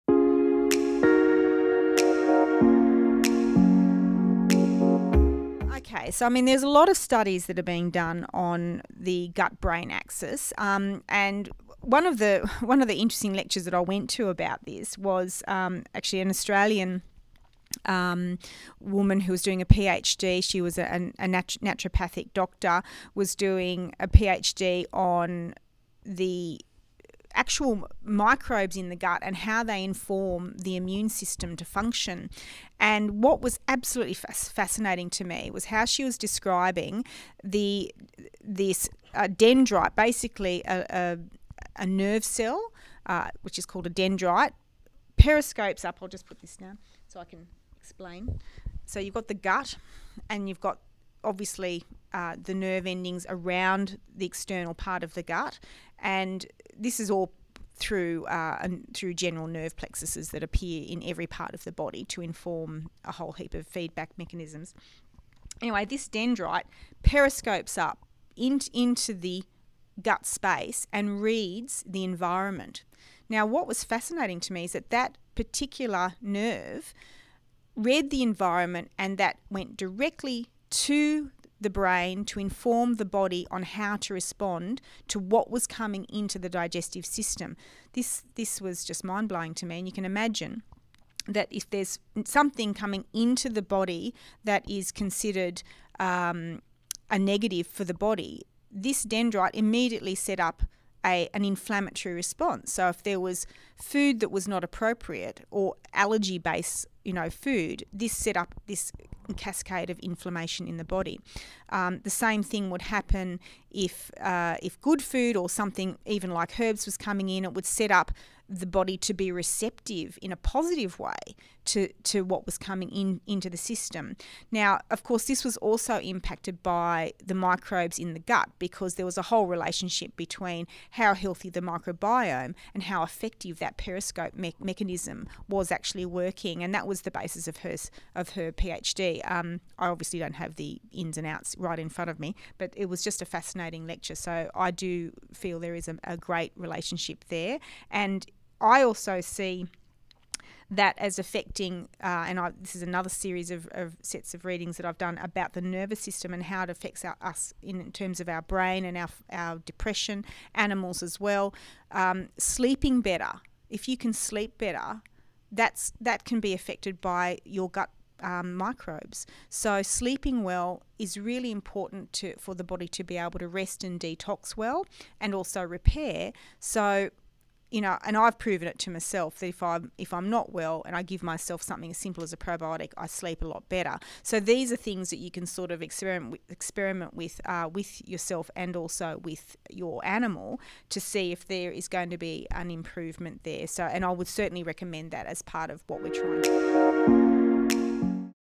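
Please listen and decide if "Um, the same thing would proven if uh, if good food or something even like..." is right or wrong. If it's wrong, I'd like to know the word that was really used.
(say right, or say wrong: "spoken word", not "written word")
wrong: "happen", not "proven".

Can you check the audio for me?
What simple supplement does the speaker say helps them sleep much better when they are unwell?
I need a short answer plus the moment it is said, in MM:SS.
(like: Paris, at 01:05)
A probiotic, at 03:02.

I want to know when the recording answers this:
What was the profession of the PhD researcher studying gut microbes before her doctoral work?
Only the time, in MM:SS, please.
00:21.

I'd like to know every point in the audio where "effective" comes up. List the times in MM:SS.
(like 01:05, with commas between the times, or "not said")
02:13.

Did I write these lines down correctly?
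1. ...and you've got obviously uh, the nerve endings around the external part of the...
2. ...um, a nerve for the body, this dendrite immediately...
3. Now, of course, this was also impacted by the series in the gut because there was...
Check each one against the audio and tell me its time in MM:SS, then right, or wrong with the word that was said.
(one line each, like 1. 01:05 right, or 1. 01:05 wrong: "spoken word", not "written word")
1. 00:50 right
2. 01:35 wrong: "negative", not "nerve"
3. 02:04 wrong: "microbes", not "series".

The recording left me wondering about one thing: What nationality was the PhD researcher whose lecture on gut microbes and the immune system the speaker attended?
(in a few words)
Australian.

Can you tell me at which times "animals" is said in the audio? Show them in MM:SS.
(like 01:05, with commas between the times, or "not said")
02:40, 03:10.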